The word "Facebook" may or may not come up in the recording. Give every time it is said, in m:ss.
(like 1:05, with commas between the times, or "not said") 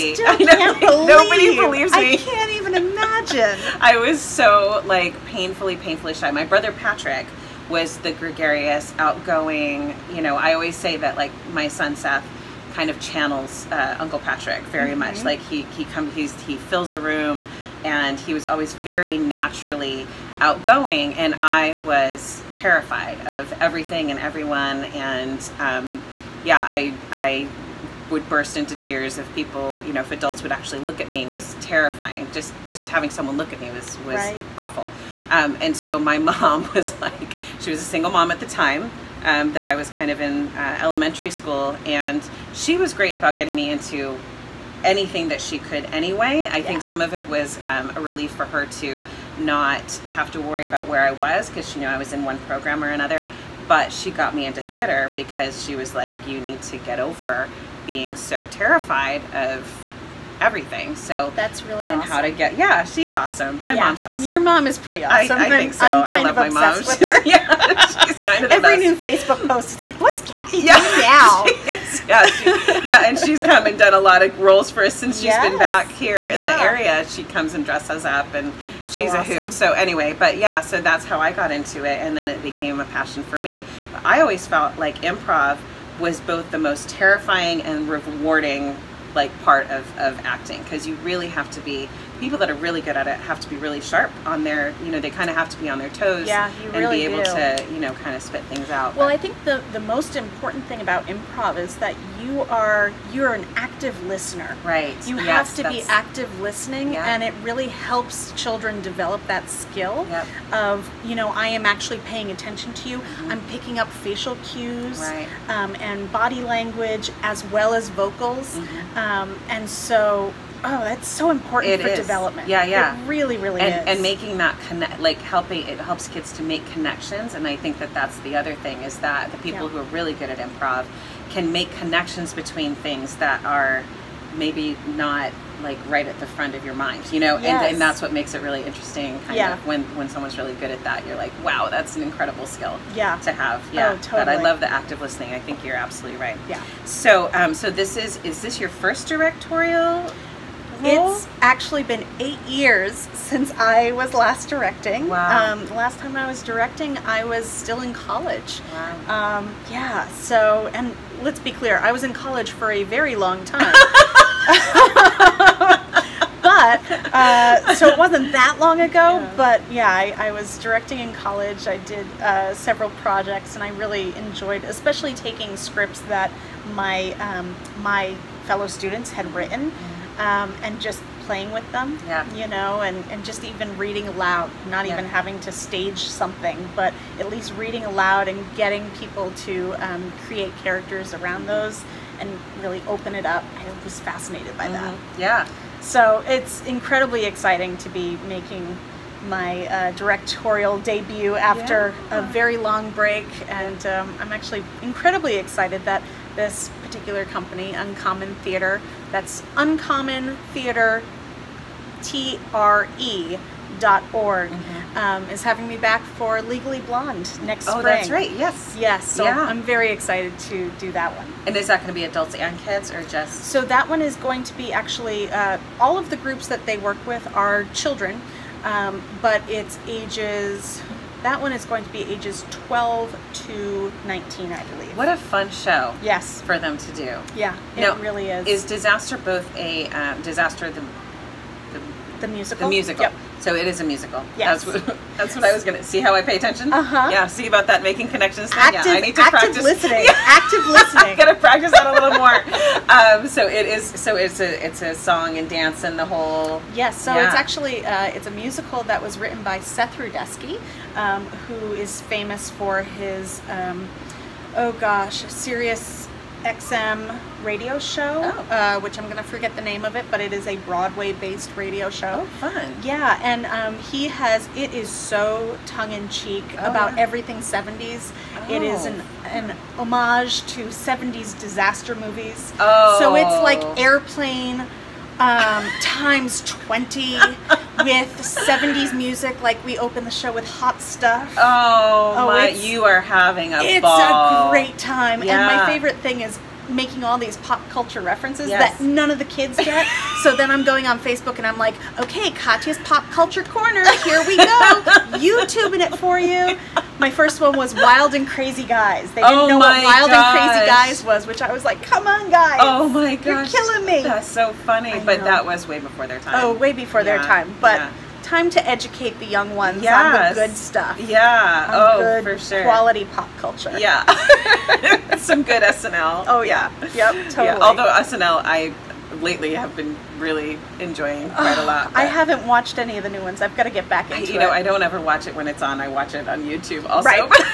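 1:08, 5:00.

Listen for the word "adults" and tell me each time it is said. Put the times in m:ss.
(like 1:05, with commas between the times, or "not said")
0:30, 3:42.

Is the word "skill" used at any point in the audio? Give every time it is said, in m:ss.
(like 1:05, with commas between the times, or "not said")
1:49, 2:22.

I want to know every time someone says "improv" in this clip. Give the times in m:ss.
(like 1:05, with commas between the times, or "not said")
1:24, 1:41, 2:10.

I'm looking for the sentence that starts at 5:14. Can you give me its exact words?
But that was way before their oh, time.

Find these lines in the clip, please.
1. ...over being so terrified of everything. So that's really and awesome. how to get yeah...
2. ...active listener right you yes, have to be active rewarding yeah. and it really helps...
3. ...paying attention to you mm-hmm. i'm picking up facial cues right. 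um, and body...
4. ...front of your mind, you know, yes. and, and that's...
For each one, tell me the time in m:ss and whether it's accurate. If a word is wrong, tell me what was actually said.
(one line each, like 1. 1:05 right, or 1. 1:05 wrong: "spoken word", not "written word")
1. 0:56 right
2. 1:43 wrong: "listening", not "rewarding"
3. 1:51 right
4. 2:16 right.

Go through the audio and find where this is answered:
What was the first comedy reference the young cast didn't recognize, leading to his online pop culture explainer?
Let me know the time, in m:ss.
5:07.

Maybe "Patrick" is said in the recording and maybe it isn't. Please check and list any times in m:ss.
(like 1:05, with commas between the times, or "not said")
0:06, 0:14.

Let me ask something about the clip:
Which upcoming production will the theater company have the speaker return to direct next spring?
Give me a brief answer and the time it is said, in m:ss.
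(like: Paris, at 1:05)
Legally Blonde, at 3:36.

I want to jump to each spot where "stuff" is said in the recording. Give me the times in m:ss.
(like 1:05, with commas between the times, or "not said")
4:50, 5:20.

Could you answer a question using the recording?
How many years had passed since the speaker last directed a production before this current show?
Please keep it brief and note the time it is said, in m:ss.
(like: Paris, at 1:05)
8, at 2:32.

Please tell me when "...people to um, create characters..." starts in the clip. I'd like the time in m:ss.
3:08.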